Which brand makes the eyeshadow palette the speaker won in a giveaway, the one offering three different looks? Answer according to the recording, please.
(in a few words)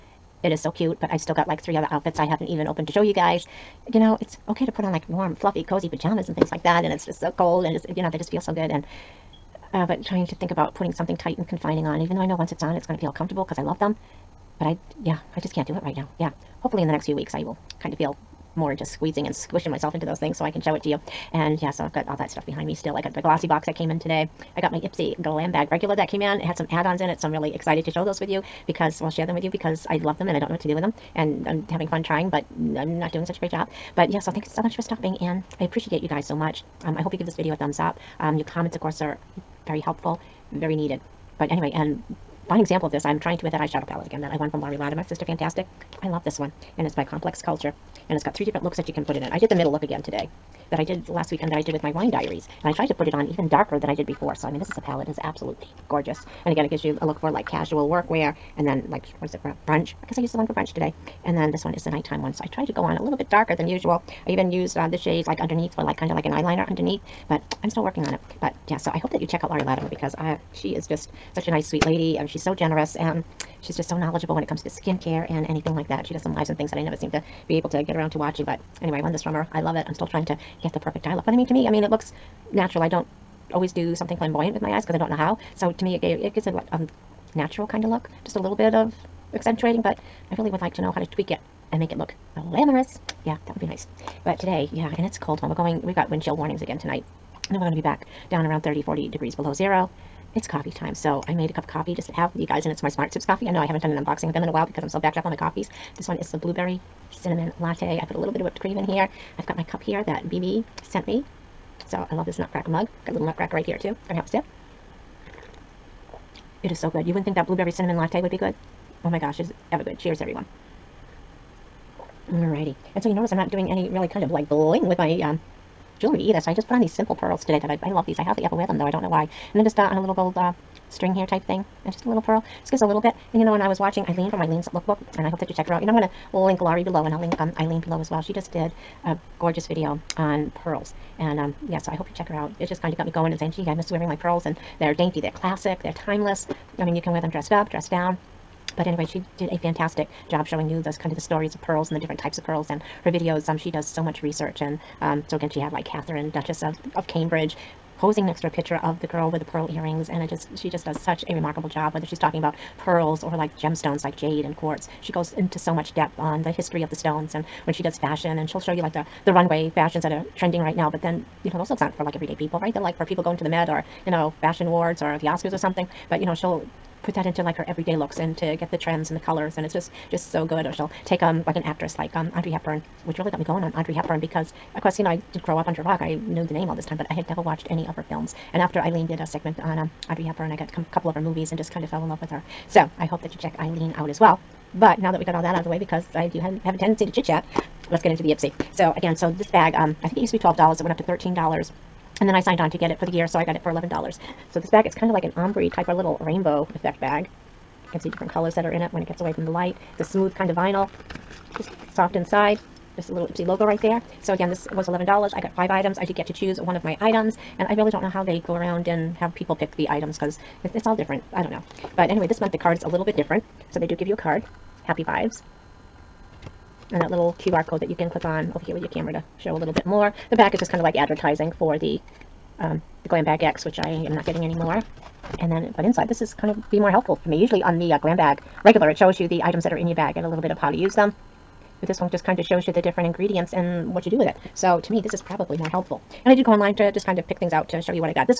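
Complex Culture.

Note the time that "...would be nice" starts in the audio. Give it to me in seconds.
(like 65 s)
93 s.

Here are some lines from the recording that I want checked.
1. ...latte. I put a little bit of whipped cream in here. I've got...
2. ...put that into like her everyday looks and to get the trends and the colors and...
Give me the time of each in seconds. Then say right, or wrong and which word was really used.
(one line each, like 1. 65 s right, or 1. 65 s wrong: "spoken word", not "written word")
1. 107 s right
2. 177 s right.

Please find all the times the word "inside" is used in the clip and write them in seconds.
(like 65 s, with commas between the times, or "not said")
212 s, 235 s.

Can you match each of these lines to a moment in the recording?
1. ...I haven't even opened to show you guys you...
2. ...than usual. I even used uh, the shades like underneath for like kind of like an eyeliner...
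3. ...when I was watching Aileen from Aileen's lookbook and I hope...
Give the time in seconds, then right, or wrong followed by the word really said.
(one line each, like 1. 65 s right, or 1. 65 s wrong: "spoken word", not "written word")
1. 2 s right
2. 63 s right
3. 133 s right.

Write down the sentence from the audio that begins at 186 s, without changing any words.
I knew the name all this time, but I had never watched any of her films.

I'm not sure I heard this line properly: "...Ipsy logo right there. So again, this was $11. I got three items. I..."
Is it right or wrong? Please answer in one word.
wrong.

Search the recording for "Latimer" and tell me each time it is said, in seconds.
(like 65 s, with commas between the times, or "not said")
44 s, 69 s.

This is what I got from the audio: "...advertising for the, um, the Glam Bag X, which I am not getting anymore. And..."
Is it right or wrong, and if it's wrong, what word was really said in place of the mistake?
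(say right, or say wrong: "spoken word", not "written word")
right.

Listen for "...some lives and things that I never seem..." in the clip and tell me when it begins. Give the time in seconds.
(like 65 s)
76 s.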